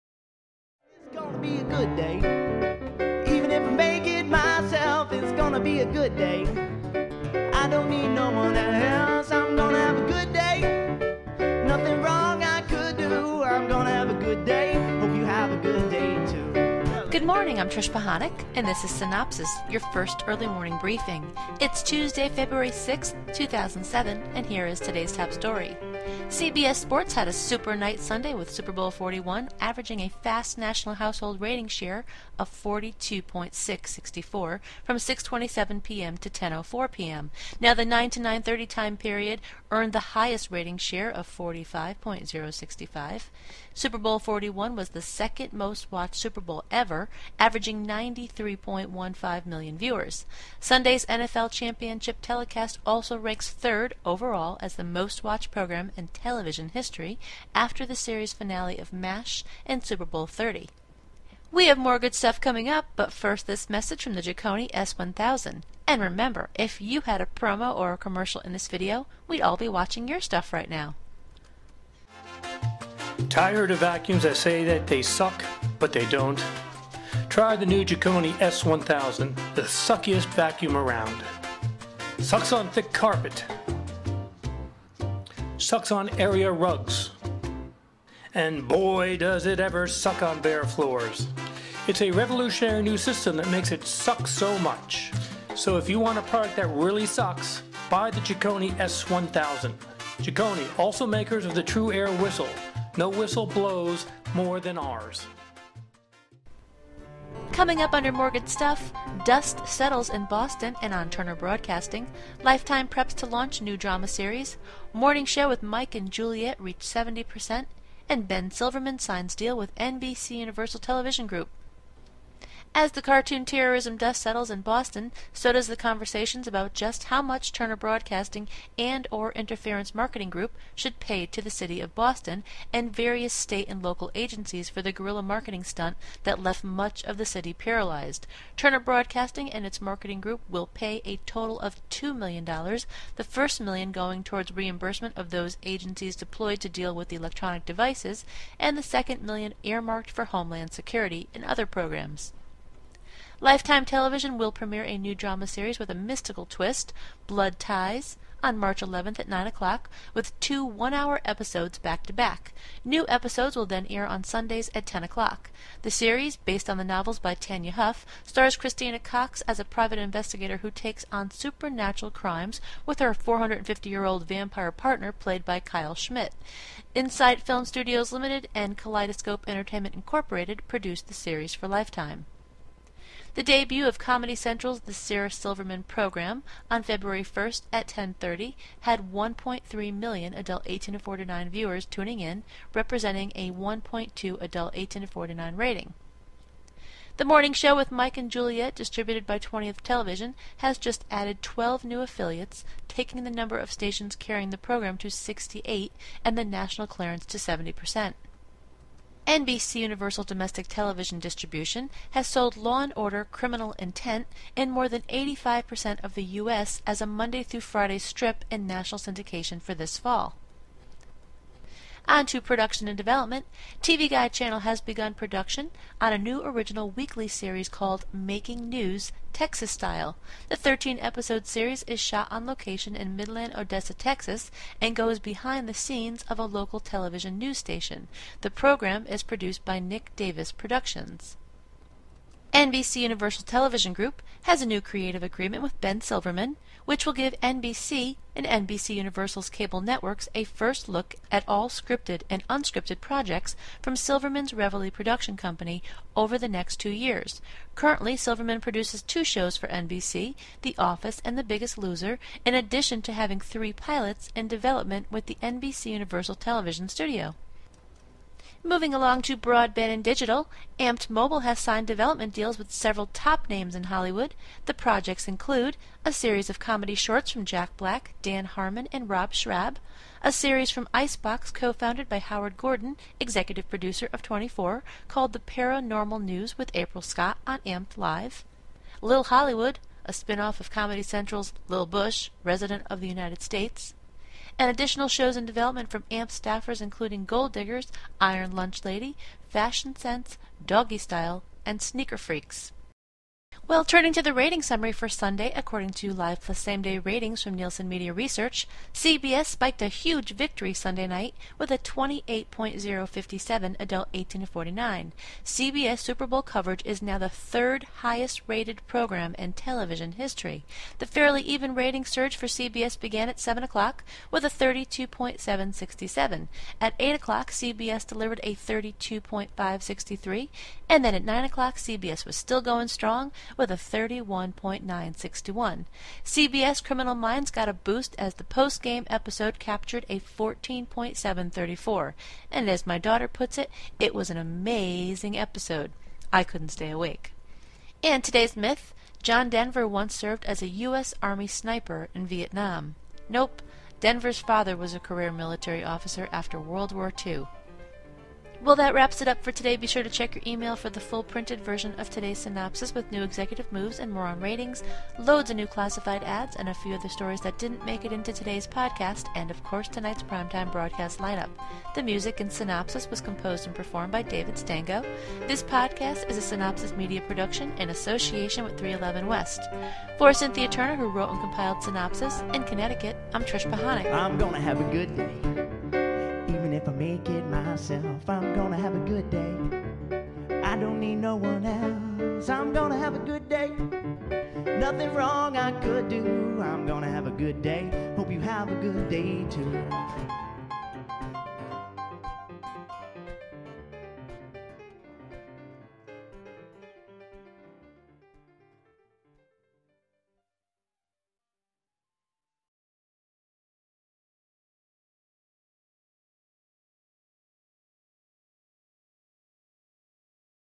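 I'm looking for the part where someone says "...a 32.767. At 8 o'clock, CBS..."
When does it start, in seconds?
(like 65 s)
324 s.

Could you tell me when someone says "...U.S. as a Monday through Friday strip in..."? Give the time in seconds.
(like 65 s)
216 s.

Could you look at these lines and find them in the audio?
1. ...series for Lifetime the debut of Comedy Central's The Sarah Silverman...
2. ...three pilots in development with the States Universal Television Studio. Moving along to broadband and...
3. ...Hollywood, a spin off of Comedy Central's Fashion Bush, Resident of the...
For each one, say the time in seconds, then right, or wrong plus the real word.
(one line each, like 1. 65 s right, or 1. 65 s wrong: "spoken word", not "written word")
1. 181 s right
2. 263 s wrong: "NBC", not "States"
3. 289 s wrong: "Lil", not "Fashion".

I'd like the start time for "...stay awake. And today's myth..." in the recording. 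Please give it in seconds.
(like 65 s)
346 s.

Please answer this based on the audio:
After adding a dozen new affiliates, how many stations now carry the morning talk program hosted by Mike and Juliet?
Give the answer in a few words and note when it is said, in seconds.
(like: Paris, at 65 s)
68, at 205 s.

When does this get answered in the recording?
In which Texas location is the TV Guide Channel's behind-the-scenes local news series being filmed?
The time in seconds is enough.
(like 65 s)
233 s.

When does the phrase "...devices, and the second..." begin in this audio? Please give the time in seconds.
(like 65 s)
147 s.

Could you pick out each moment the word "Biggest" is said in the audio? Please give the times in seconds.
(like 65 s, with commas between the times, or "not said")
261 s.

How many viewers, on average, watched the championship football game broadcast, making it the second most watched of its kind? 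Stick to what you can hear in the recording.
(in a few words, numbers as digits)
93.15 million.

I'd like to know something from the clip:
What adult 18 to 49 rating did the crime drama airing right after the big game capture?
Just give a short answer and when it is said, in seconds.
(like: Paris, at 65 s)
14.734, at 340 s.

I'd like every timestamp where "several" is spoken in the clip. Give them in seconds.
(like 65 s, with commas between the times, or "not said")
272 s.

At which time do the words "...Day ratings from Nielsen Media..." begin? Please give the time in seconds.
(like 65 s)
306 s.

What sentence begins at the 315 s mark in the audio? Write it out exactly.
CBS Super Bowl coverage is now the third highest rated program in television history.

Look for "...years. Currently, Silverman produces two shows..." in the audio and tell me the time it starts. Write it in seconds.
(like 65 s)
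256 s.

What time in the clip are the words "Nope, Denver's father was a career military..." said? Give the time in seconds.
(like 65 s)
353 s.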